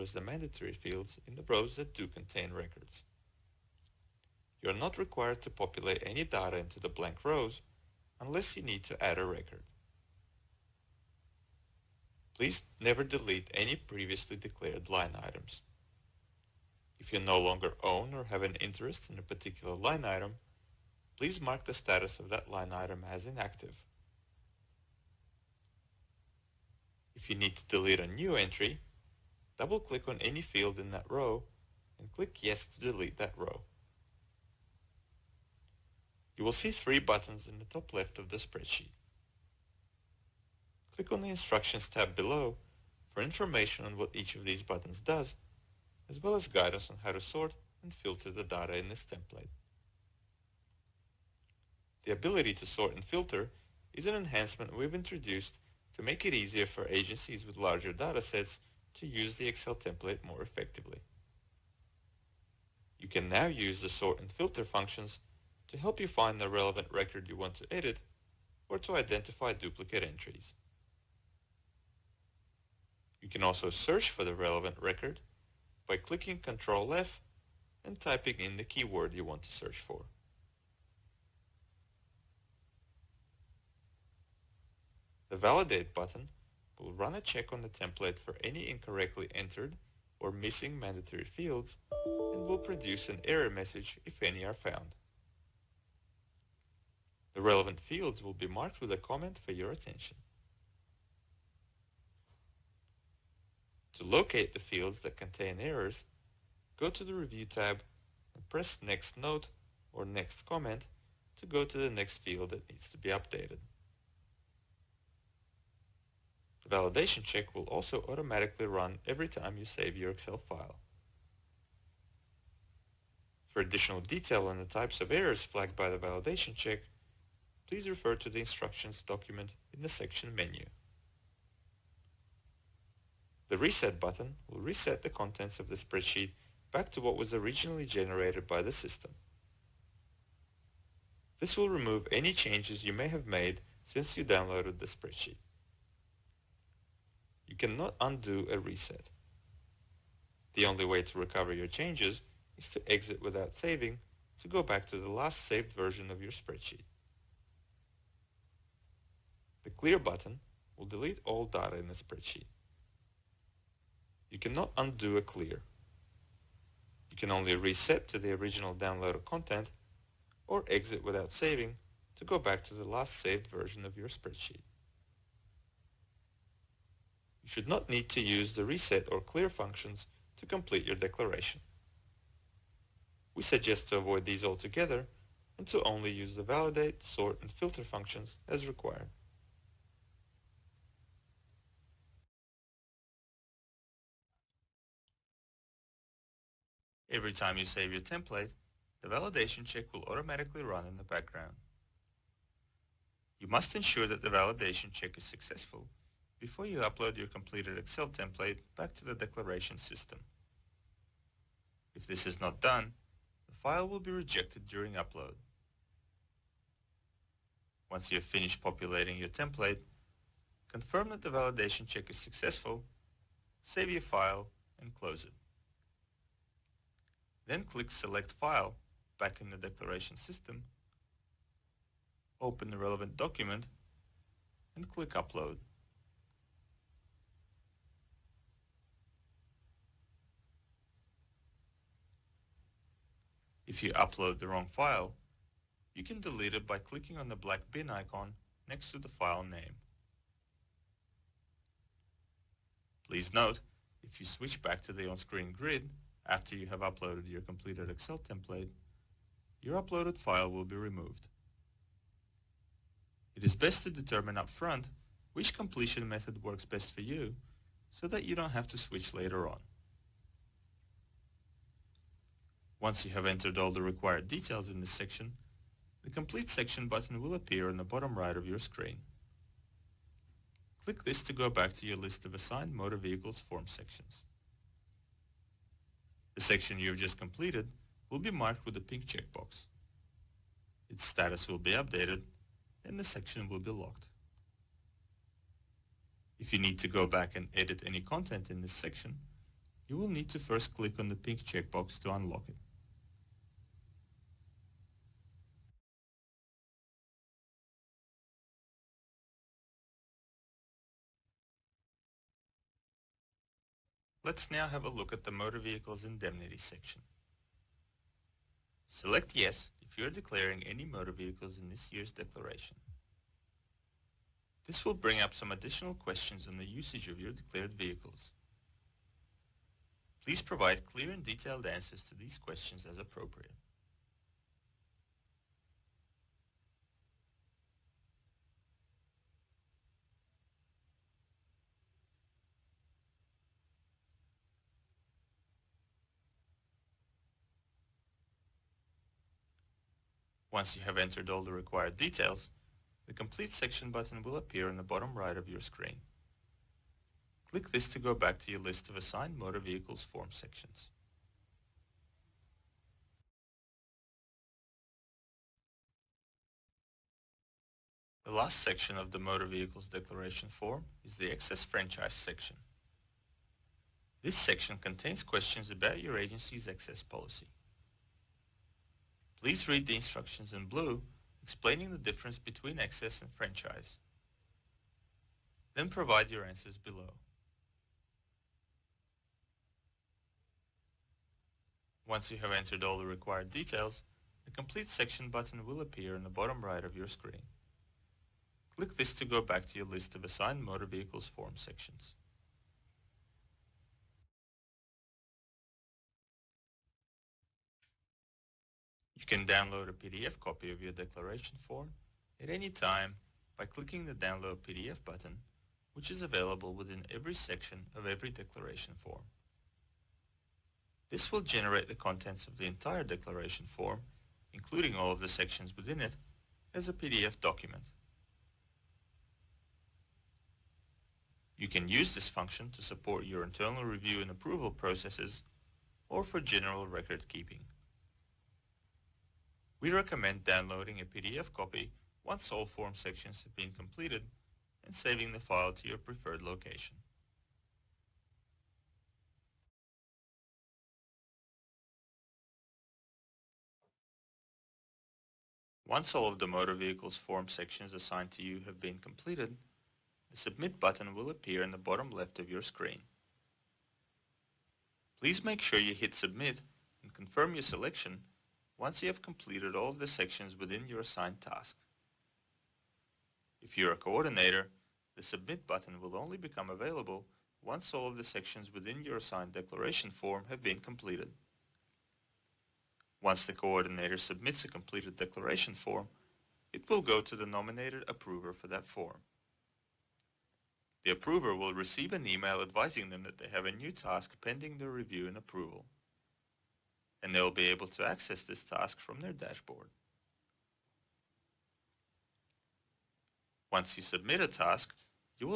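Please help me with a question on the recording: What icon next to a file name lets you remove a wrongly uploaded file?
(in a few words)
black bin icon.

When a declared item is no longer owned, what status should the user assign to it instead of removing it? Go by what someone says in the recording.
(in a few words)
inactive.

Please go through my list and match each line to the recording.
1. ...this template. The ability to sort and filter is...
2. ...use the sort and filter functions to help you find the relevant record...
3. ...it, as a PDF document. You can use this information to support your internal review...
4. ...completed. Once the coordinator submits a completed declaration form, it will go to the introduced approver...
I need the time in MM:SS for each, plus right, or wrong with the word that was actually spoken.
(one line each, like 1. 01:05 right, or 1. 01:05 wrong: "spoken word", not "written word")
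1. 00:48 right
2. 01:03 right
3. 07:06 wrong: "function", not "information"
4. 08:00 wrong: "nominated", not "introduced".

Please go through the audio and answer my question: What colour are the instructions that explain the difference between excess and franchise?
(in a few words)
blue.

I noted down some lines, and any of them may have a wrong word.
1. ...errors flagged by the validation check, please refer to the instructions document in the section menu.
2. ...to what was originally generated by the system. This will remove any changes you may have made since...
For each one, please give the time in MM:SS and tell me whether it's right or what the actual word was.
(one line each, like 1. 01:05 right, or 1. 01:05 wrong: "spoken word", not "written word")
1. 02:05 right
2. 02:16 right.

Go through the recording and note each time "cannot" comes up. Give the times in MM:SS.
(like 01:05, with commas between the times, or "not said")
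02:27, 02:44.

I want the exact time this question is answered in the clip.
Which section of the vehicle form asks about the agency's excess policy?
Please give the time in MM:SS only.
06:11.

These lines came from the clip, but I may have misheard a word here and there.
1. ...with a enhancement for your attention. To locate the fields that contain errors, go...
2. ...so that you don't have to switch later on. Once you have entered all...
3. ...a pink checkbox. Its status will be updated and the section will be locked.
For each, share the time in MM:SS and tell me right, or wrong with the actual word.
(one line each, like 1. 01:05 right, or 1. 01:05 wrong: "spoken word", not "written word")
1. 01:38 wrong: "comment", not "enhancement"
2. 04:27 right
3. 04:48 right.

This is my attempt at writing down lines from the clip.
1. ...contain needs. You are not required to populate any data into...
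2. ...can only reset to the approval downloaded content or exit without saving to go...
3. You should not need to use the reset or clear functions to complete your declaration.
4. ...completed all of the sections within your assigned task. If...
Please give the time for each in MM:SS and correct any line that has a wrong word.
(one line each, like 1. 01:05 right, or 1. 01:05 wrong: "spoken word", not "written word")
1. 00:02 wrong: "records", not "needs"
2. 02:47 wrong: "original", not "approval"
3. 02:57 right
4. 07:49 right.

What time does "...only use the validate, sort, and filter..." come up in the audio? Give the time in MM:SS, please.
03:05.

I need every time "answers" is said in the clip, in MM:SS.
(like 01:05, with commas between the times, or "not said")
05:31, 06:26.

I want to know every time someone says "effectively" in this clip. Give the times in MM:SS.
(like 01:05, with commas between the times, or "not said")
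01:00.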